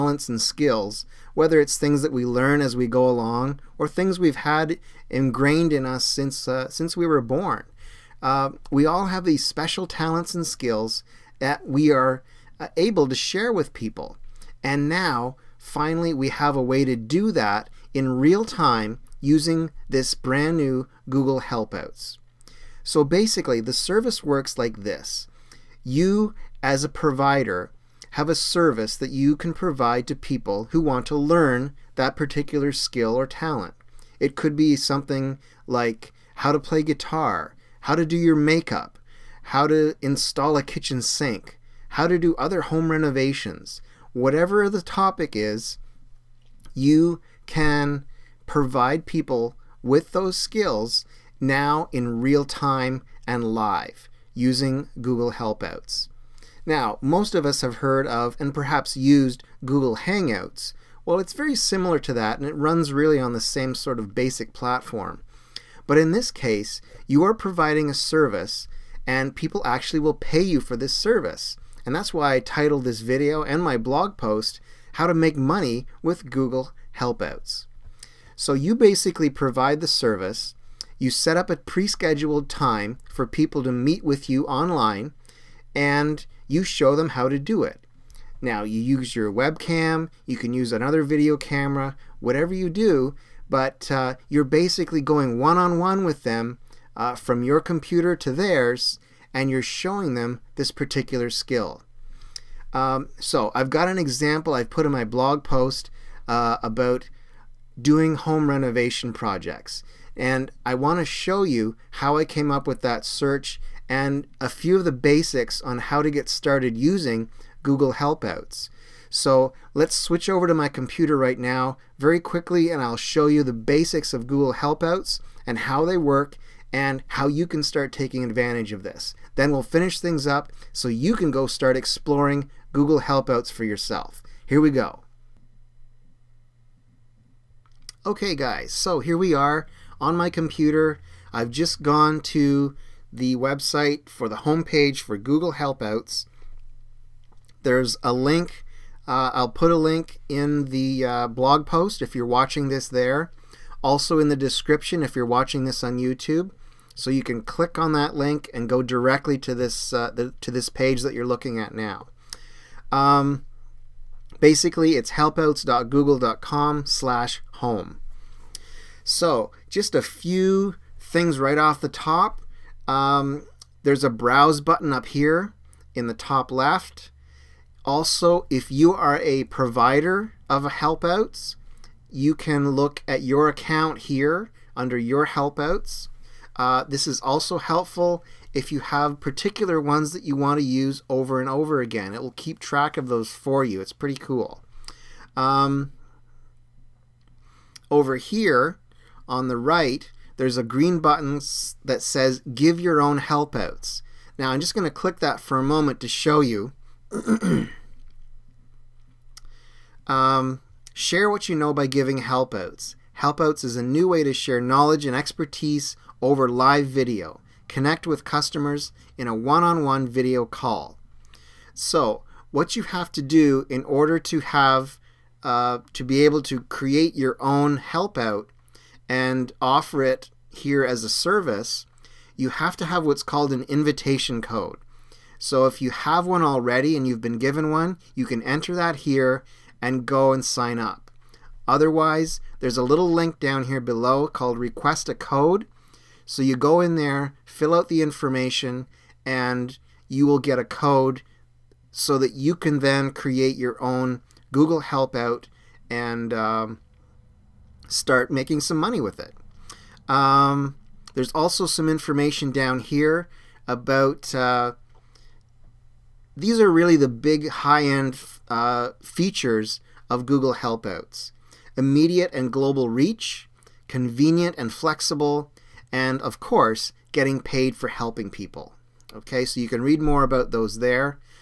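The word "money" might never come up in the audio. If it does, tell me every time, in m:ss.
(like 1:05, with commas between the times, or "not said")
1:15, 4:18.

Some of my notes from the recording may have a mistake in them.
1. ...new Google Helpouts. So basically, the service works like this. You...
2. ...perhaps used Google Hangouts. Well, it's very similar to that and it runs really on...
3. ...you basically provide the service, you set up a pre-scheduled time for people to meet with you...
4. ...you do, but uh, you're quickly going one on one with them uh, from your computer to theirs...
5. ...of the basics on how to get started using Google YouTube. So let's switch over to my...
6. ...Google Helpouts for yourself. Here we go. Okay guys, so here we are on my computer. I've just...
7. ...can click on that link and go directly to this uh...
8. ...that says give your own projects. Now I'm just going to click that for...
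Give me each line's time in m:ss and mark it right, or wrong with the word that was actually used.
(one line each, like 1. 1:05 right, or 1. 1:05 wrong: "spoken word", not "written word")
1. 0:20 right
2. 0:58 right
3. 1:18 right
4. 1:32 wrong: "basically", not "quickly"
5. 1:54 wrong: "Helpouts", not "YouTube"
6. 2:12 right
7. 2:37 right
8. 3:21 wrong: "helpouts", not "projects".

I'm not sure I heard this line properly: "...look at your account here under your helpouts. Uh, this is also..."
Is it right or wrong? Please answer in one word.
right.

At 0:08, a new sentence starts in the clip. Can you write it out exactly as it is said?
Uh, we all have these special talents and skills that we are uh, able to share with people.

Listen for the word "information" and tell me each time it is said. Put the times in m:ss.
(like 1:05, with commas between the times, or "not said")
4:08, 4:21.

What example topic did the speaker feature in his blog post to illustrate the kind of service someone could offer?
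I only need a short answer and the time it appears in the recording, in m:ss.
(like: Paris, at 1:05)
home renovation projects, at 1:48.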